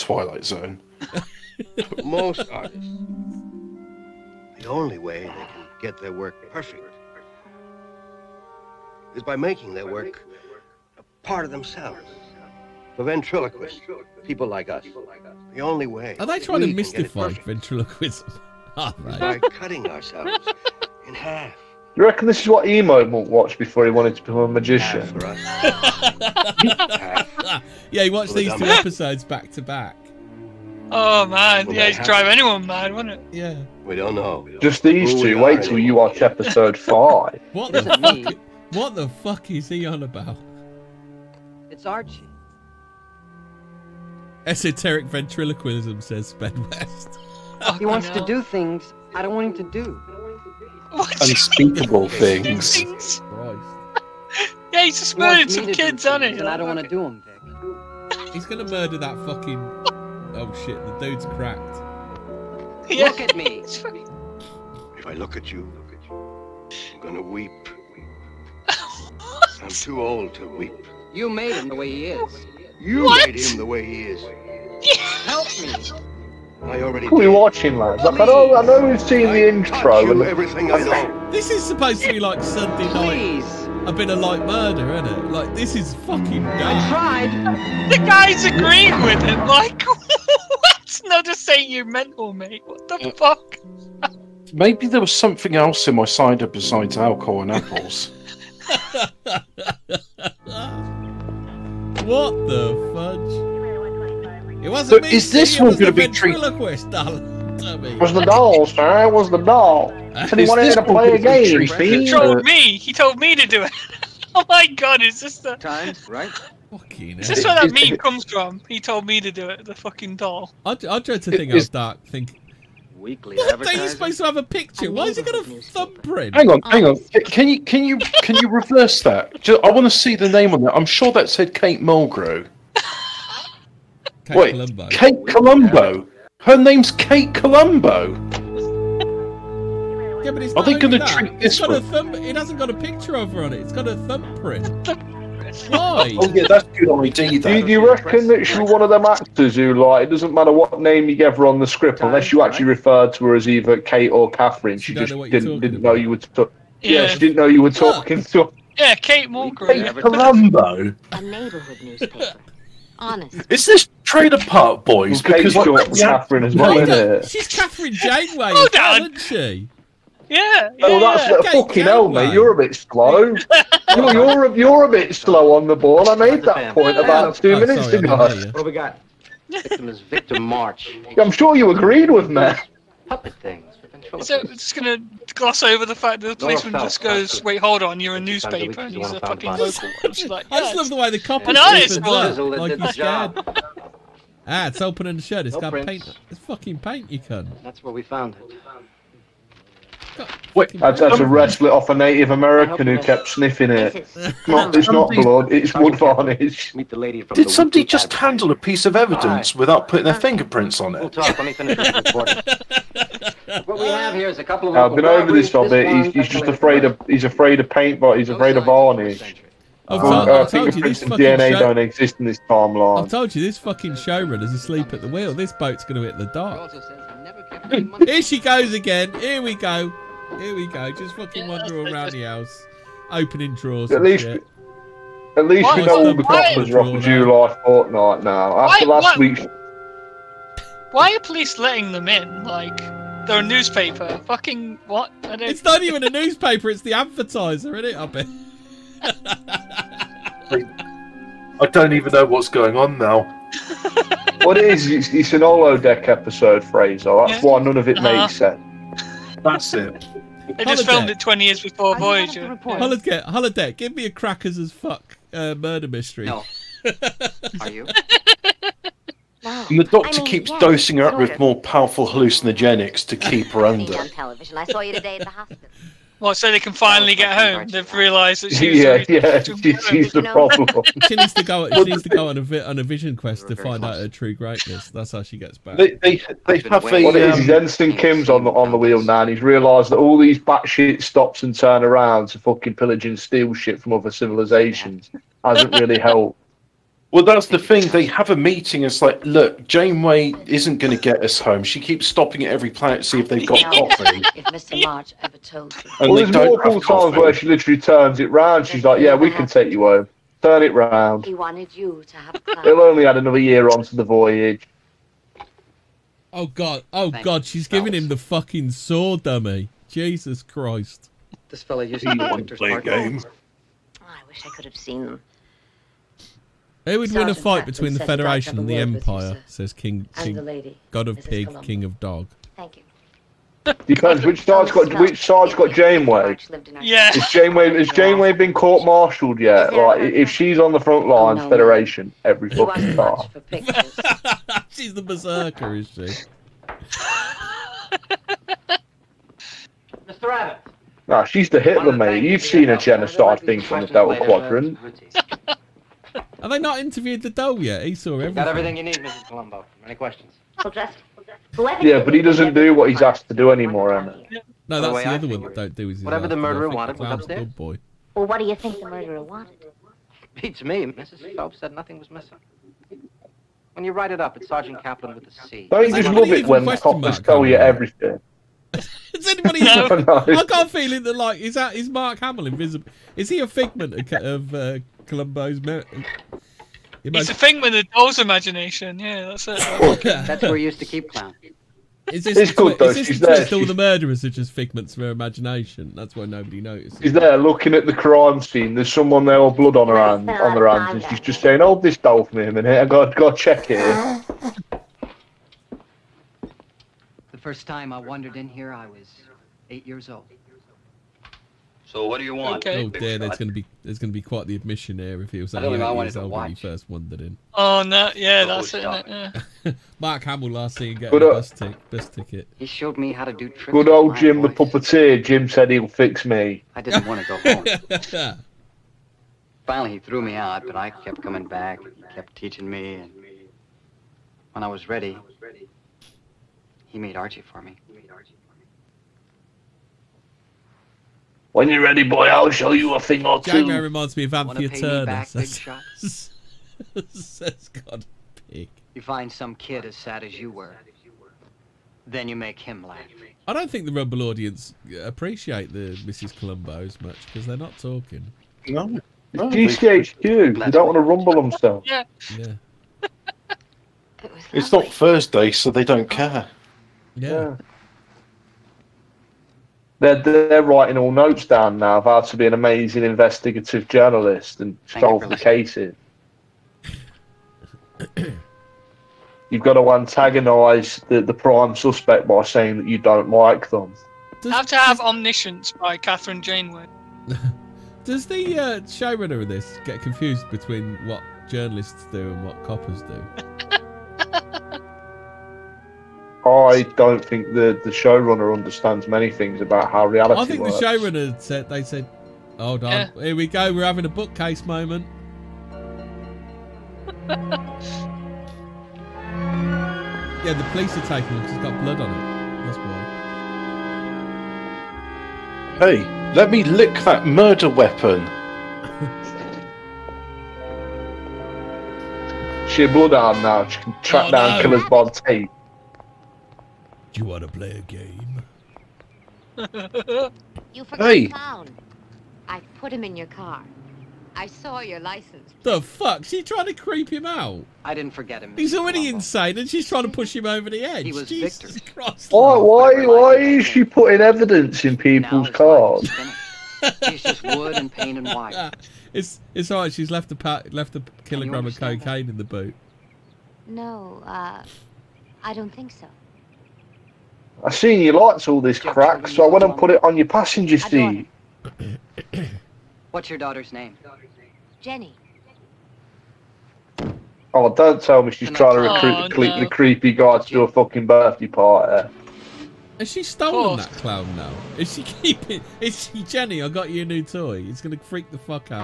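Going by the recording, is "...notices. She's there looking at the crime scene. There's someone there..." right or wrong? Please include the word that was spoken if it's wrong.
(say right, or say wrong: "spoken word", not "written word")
right.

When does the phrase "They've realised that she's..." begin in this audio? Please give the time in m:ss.
4:37.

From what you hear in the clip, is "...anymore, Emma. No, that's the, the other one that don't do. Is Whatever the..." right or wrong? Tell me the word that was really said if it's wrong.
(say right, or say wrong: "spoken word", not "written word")
right.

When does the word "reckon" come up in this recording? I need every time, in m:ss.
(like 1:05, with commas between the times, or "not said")
0:22, 2:27.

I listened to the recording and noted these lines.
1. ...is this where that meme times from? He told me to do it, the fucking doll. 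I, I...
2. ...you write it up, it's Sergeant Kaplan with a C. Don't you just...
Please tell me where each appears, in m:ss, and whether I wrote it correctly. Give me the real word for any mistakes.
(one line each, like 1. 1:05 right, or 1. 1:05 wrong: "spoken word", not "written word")
1. 1:57 wrong: "comes", not "times"
2. 6:13 right.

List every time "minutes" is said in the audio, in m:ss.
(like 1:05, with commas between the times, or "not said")
2:57, 6:42.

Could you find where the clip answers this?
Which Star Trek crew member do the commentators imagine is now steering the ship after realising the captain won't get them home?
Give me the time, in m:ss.
4:47.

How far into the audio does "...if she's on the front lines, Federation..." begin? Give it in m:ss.
5:40.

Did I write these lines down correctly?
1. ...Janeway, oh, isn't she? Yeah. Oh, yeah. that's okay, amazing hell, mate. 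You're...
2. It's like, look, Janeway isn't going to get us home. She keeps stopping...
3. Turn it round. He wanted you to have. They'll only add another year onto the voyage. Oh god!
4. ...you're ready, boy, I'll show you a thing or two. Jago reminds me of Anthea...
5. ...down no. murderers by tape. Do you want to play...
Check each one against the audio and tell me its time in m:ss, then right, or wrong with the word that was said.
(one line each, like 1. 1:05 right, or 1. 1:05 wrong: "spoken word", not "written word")
1. 2:47 wrong: "fucking", not "amazing"
2. 4:58 right
3. 5:10 right
4. 7:21 right
5. 8:44 wrong: "killers", not "murderers".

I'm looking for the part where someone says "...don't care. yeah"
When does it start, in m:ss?
7:45.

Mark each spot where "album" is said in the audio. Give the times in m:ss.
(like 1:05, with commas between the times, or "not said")
6:56.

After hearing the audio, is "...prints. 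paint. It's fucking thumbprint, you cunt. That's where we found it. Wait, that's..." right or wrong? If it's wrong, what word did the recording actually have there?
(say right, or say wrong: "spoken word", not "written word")
wrong: "paint", not "thumbprint".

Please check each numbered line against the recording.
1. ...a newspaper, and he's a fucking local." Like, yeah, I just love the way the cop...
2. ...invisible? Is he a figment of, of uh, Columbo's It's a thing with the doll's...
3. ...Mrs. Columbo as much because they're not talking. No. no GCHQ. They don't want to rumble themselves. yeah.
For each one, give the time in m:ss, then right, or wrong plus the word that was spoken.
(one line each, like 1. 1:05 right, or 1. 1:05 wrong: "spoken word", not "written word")
1. 3:08 right
2. 6:22 right
3. 7:36 right.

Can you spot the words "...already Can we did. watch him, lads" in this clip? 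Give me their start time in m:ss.
1:16.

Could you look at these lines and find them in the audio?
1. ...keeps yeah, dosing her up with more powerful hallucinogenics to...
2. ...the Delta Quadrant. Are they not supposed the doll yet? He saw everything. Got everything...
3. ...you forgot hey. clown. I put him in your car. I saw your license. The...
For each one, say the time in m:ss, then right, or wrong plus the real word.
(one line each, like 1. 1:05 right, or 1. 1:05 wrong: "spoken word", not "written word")
1. 4:30 right
2. 5:53 wrong: "interviewed", not "supposed"
3. 8:50 right.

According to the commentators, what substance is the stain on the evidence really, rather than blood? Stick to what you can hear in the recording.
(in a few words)
Wood varnish.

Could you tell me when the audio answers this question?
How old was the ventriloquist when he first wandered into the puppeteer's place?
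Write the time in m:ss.
6:49.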